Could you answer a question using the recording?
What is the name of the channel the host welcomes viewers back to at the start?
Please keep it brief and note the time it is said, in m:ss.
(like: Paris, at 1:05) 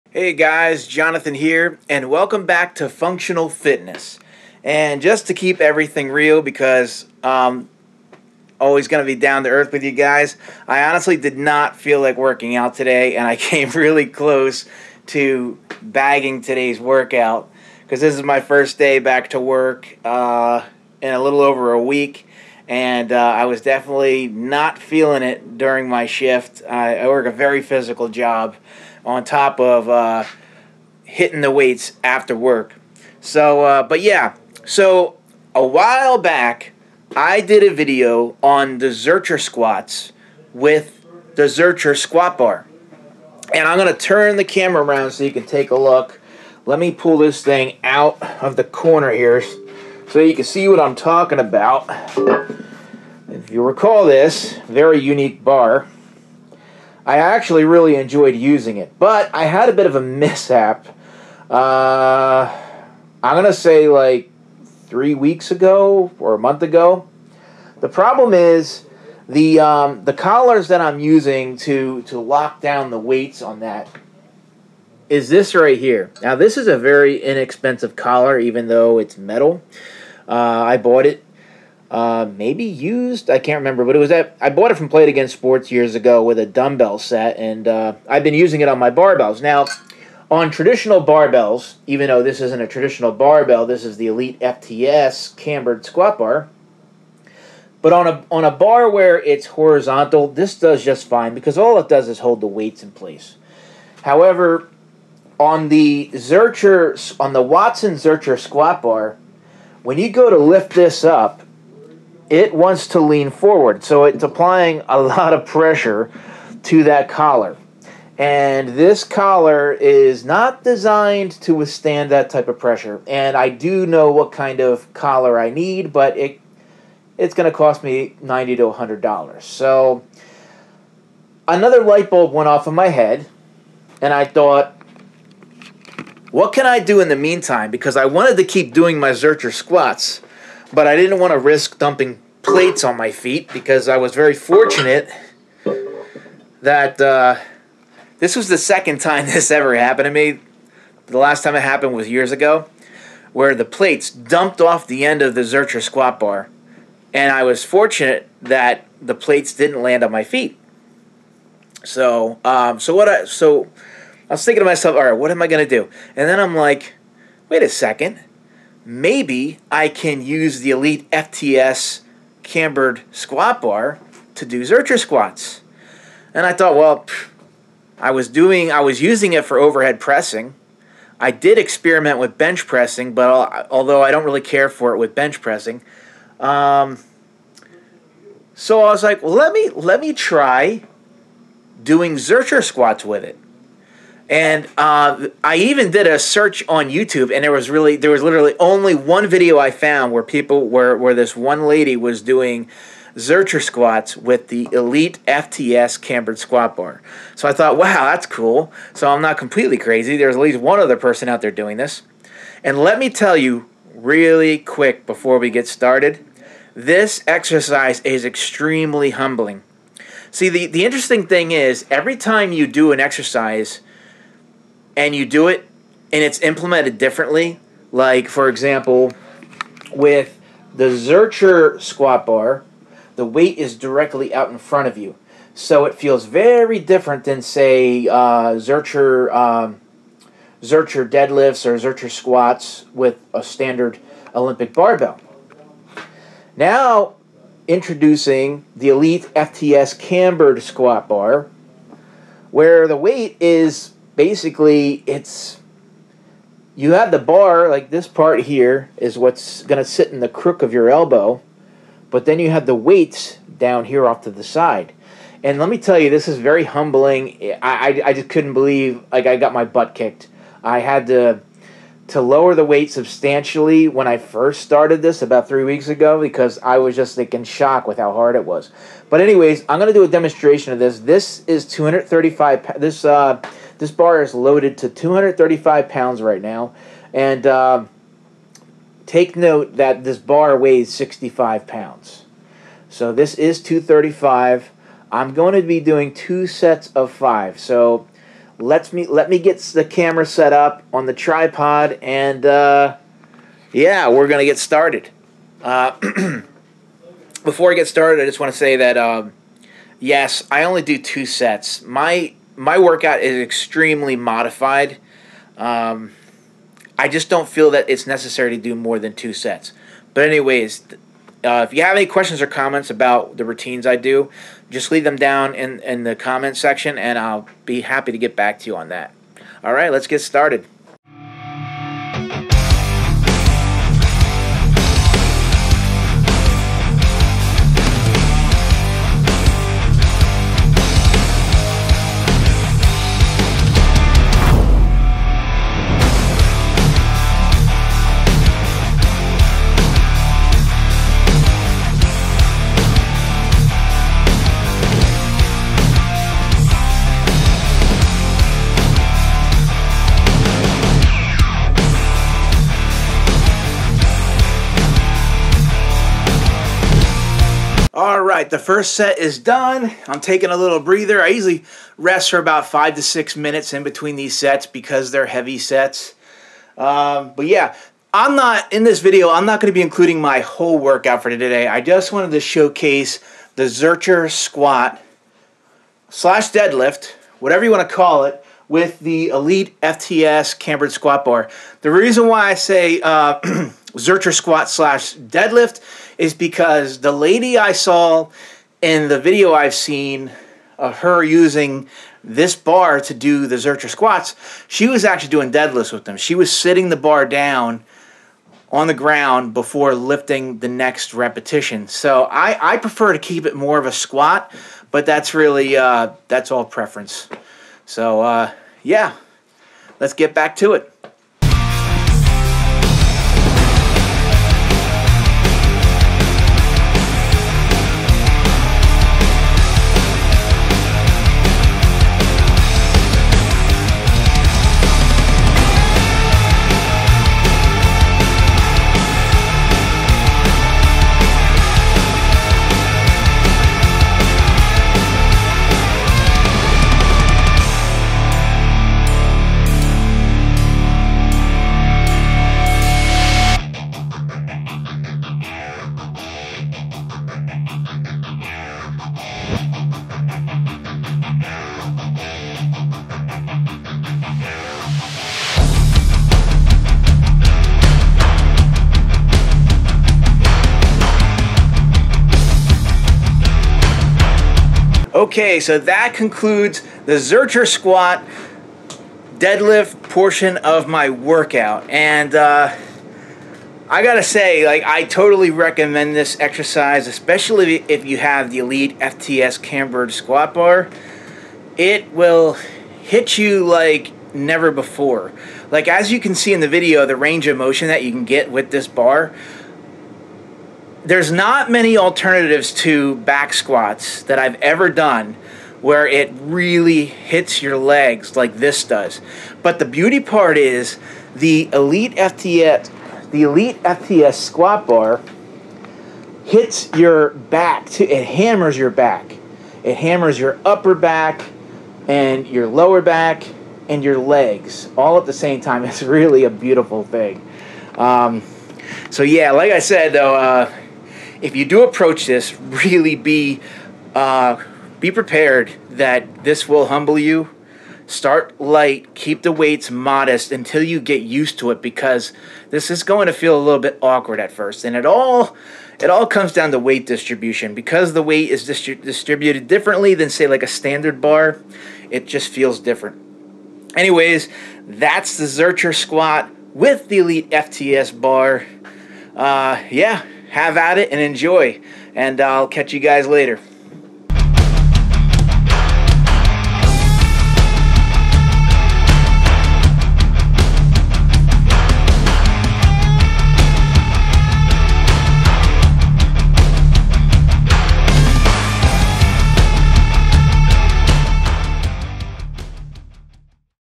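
Functional Fitness, at 0:02.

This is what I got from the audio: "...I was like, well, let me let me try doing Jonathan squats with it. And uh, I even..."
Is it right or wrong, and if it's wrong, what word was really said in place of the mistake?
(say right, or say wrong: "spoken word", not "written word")
wrong: "Zercher", not "Jonathan".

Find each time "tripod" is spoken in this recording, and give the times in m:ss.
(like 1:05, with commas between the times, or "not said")
5:01.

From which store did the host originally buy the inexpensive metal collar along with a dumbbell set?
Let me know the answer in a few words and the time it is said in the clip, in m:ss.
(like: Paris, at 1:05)
Play It Again Sports, at 1:24.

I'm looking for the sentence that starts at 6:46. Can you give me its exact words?
She was sitting the bar down on the ground before lifting the next repetition.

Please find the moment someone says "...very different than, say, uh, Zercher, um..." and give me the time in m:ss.
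3:56.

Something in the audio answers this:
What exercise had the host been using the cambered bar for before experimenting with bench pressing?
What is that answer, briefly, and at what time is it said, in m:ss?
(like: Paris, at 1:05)
overhead pressing, at 2:59.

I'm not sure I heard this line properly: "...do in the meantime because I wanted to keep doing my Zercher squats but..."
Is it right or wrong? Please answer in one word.
right.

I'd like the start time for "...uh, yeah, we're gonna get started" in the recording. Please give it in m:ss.
5:02.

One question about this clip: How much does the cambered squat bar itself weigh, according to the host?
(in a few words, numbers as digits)
65 pounds.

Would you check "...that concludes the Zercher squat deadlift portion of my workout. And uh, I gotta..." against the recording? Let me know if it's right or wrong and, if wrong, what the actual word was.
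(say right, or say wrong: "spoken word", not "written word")
right.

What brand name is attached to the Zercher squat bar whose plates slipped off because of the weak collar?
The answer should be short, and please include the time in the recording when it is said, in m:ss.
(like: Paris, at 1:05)
Watson, at 1:47.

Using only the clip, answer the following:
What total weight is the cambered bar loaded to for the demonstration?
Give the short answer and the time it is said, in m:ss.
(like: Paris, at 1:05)
235 pounds, at 4:44.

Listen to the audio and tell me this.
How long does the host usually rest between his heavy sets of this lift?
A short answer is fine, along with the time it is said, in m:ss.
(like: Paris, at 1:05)
5 to 6 minutes, at 6:12.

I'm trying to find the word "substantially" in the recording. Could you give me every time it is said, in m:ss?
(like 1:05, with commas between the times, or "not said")
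4:32.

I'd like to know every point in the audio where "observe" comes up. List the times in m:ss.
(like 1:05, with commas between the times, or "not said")
not said.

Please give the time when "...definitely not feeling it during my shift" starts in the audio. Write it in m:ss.
0:23.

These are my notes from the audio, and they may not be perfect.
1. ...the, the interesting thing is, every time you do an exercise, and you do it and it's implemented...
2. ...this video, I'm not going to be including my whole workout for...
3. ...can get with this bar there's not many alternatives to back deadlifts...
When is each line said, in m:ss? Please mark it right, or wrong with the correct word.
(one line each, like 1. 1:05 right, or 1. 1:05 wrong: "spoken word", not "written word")
1. 3:40 right
2. 6:18 right
3. 8:18 wrong: "squats", not "deadlifts".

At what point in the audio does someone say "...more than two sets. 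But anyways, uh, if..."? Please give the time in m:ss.
5:18.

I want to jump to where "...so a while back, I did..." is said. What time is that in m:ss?
0:34.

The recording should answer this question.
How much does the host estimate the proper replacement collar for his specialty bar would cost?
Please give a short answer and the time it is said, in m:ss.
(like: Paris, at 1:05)
$90 to $100, at 2:08.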